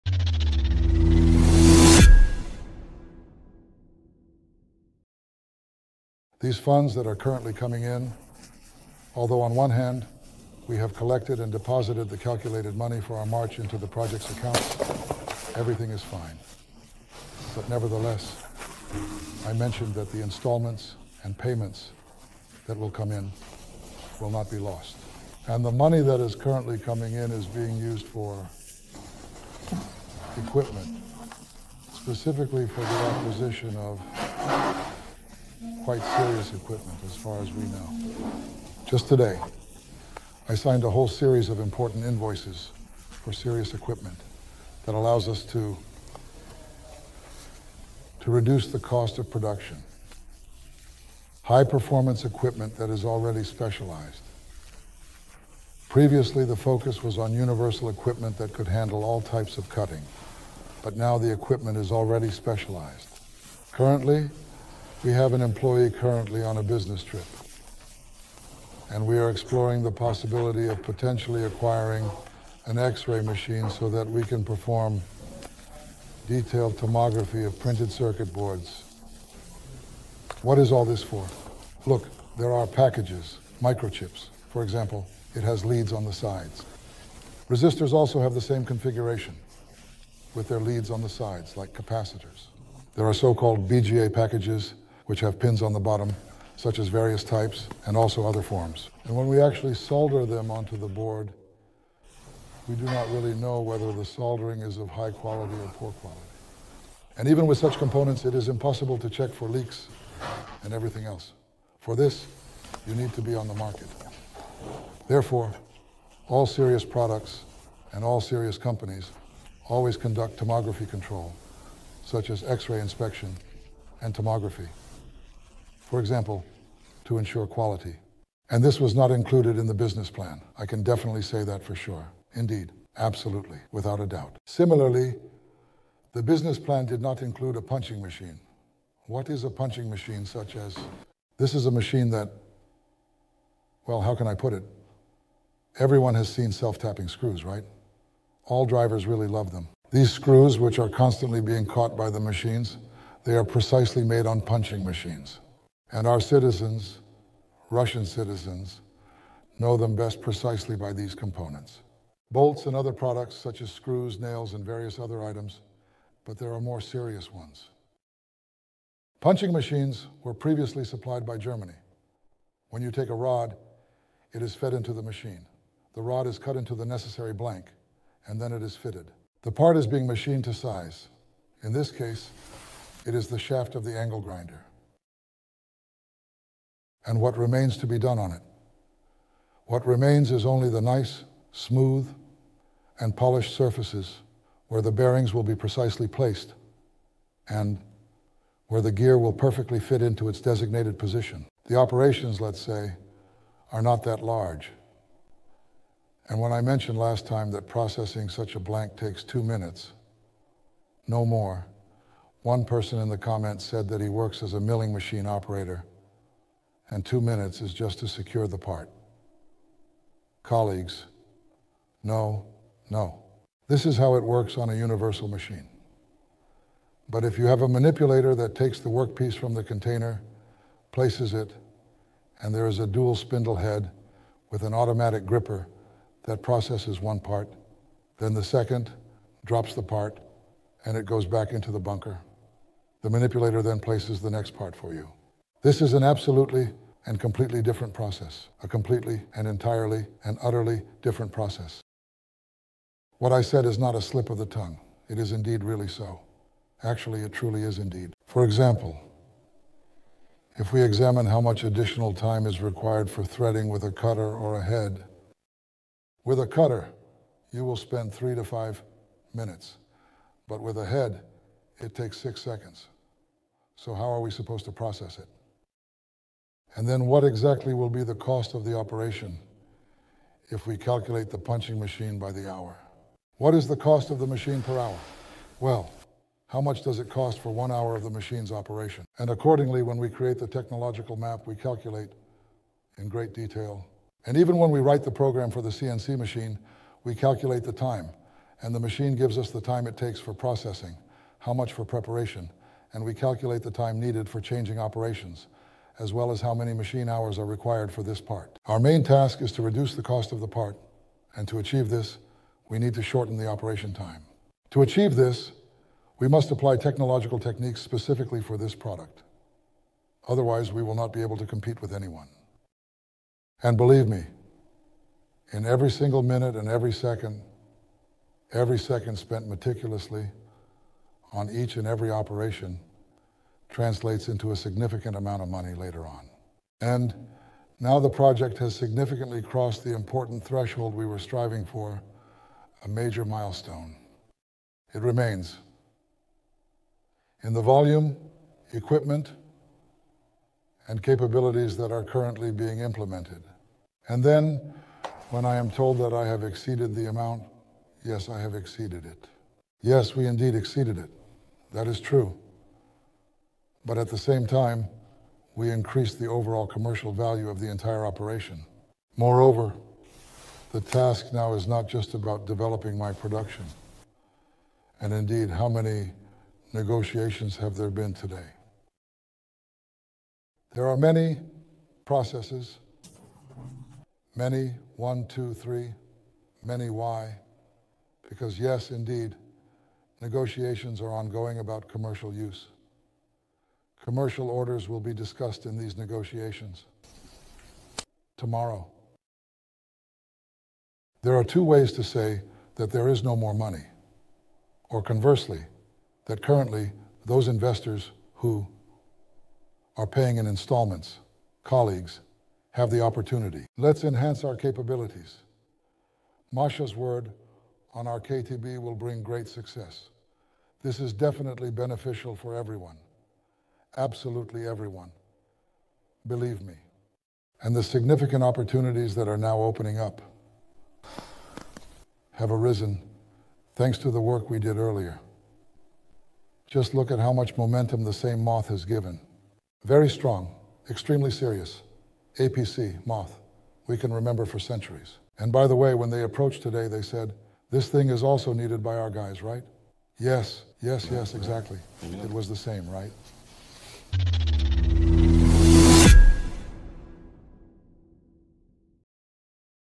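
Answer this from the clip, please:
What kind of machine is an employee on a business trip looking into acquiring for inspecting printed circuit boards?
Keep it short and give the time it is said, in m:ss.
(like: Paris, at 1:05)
X-ray machine, at 1:12.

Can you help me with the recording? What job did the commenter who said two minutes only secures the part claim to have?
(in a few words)
milling machine operator.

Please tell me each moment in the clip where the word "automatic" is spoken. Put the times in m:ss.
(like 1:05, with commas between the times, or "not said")
3:54.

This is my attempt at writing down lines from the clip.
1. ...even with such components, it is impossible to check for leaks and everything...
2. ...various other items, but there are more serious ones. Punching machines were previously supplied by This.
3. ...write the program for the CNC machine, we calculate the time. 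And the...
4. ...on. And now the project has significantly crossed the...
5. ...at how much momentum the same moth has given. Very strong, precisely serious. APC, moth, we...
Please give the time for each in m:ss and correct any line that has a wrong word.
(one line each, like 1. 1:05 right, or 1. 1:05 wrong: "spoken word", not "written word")
1. 1:47 right
2. 2:44 wrong: "Germany", not "This"
3. 4:54 right
4. 5:36 right
5. 7:17 wrong: "extremely", not "precisely".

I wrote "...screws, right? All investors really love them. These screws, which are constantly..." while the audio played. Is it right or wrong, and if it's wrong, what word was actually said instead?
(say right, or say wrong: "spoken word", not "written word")
wrong: "drivers", not "investors".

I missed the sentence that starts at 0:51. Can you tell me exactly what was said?
High performance equipment that is already specialized.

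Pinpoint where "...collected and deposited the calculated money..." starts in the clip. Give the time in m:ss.
0:10.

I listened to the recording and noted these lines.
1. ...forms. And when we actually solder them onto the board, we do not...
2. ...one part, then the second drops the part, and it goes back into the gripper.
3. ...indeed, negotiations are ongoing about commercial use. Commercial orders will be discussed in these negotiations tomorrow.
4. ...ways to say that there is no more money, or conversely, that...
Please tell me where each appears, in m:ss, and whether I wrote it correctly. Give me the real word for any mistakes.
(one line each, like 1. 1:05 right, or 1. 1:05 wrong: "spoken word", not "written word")
1. 1:38 right
2. 3:56 wrong: "bunker", not "gripper"
3. 6:28 right
4. 6:41 right.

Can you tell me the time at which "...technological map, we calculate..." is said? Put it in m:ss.
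4:50.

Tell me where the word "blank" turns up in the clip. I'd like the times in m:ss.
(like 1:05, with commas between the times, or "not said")
2:57, 3:28.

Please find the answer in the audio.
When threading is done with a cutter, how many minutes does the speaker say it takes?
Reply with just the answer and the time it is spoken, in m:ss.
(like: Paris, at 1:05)
3 to 5 minutes, at 4:28.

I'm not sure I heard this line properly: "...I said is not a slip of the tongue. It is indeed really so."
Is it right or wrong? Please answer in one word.
right.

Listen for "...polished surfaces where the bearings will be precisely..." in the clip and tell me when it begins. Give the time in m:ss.
3:13.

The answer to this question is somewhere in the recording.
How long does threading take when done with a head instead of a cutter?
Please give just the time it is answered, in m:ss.
4:32.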